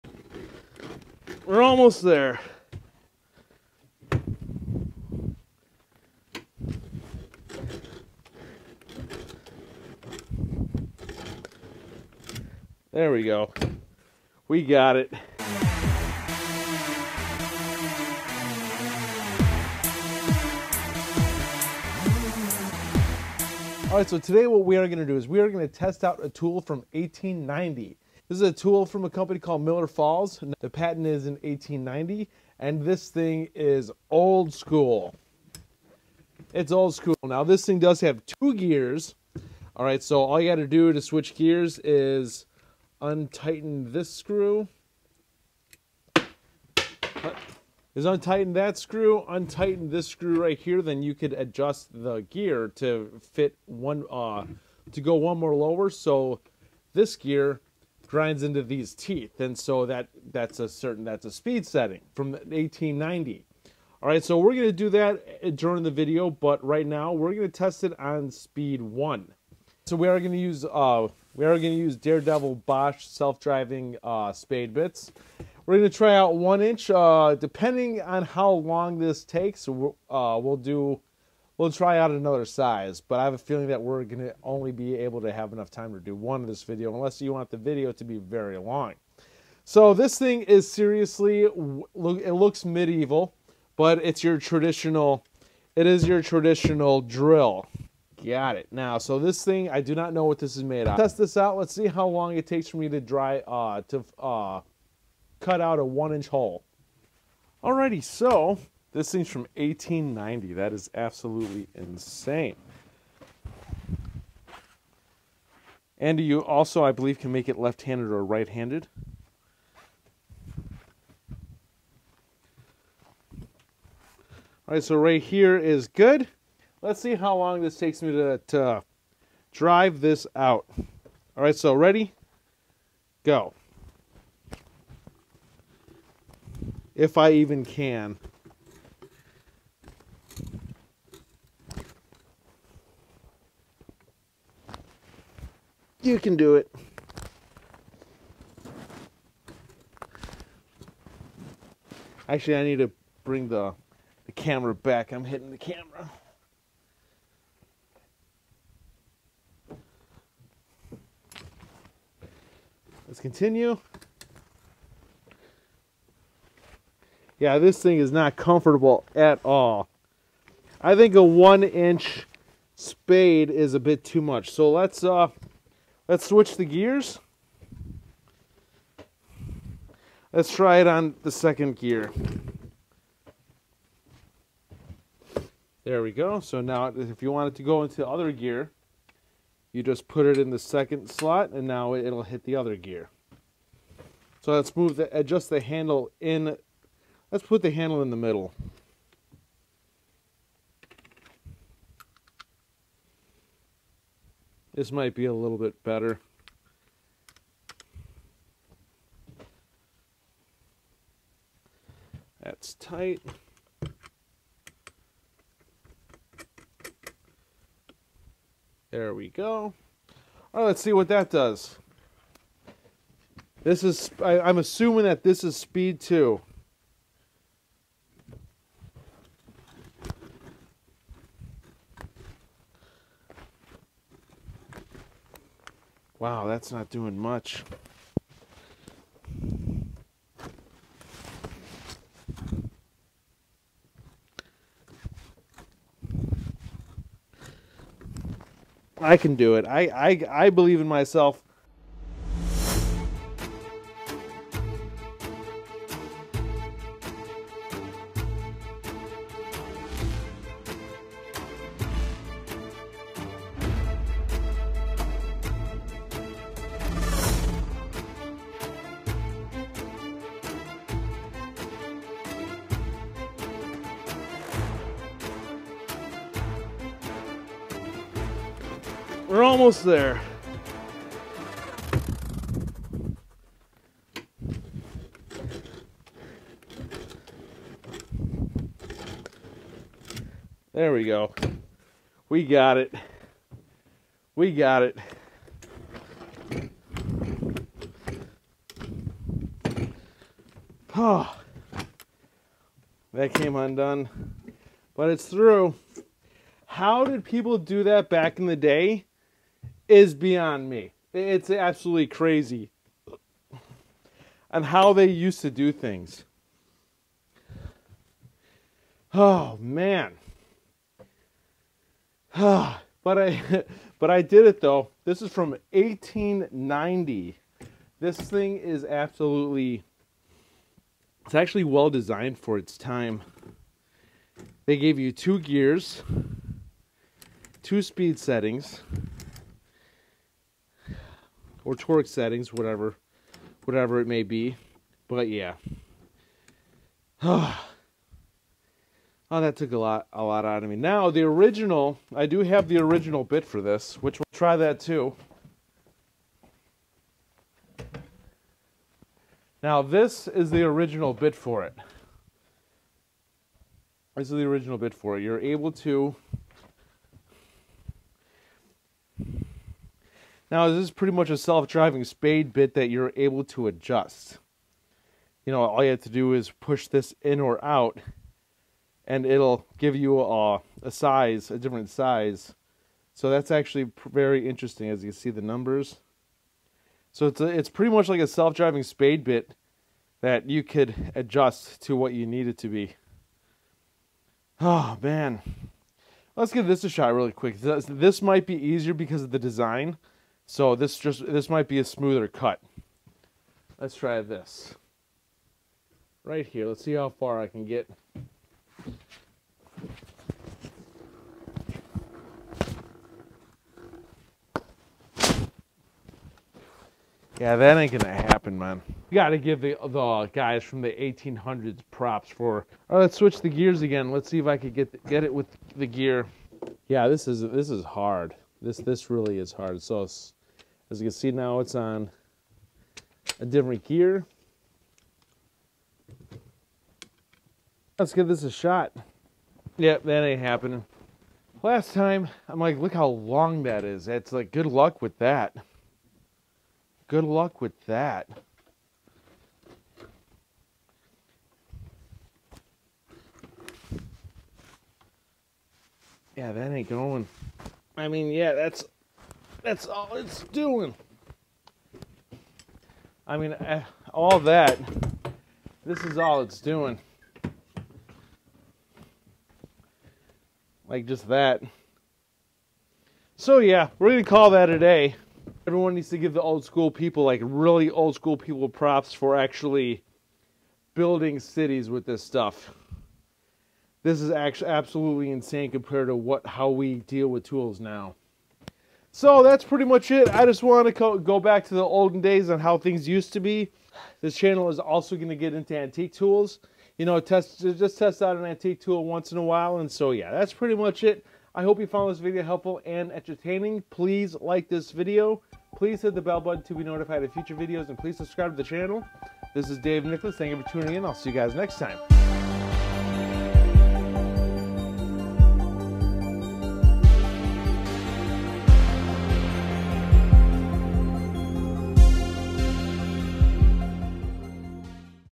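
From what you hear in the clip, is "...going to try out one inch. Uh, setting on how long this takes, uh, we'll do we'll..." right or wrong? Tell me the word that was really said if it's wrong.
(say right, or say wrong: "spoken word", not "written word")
wrong: "depending", not "setting".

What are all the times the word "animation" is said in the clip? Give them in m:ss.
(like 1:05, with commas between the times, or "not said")
not said.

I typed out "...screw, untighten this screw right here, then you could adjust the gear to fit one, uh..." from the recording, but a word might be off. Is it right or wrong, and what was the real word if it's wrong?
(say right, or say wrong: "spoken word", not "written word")
right.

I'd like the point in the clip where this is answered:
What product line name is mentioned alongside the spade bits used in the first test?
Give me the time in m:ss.
1:11.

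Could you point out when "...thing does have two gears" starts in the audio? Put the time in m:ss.
0:37.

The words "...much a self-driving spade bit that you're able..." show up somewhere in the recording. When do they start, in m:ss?
6:11.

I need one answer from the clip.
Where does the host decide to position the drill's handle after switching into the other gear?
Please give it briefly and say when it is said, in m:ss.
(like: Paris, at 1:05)
in the middle, at 3:18.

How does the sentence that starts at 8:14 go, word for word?
This channel is also going to get into antique tools.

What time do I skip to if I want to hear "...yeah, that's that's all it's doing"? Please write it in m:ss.
7:38.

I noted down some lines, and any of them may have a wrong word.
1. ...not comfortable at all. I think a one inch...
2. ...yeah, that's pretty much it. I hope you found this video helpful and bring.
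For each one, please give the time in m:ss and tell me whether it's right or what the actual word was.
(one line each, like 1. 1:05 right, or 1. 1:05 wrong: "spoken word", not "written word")
1. 2:48 right
2. 8:20 wrong: "entertaining", not "bring".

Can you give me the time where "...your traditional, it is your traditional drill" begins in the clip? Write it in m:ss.
1:34.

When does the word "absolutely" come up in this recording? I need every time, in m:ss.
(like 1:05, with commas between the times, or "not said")
1:50, 5:11, 5:28, 8:04.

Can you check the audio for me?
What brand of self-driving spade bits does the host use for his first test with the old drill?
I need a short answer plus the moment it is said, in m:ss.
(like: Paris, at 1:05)
Bosch, at 1:12.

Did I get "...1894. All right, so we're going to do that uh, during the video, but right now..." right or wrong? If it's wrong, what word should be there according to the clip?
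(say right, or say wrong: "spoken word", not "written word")
wrong: "1890", not "1894".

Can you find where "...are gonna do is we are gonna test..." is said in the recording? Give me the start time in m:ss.
0:24.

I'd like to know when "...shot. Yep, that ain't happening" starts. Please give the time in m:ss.
7:18.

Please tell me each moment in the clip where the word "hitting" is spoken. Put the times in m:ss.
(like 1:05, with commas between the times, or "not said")
2:35.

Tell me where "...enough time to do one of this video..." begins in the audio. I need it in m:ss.
1:25.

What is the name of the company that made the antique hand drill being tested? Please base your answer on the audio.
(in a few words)
Miller Falls.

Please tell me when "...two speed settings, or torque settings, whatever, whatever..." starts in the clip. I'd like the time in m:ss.
5:37.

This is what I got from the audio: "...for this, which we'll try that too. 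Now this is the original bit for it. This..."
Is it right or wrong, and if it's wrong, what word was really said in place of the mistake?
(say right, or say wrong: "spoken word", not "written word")
right.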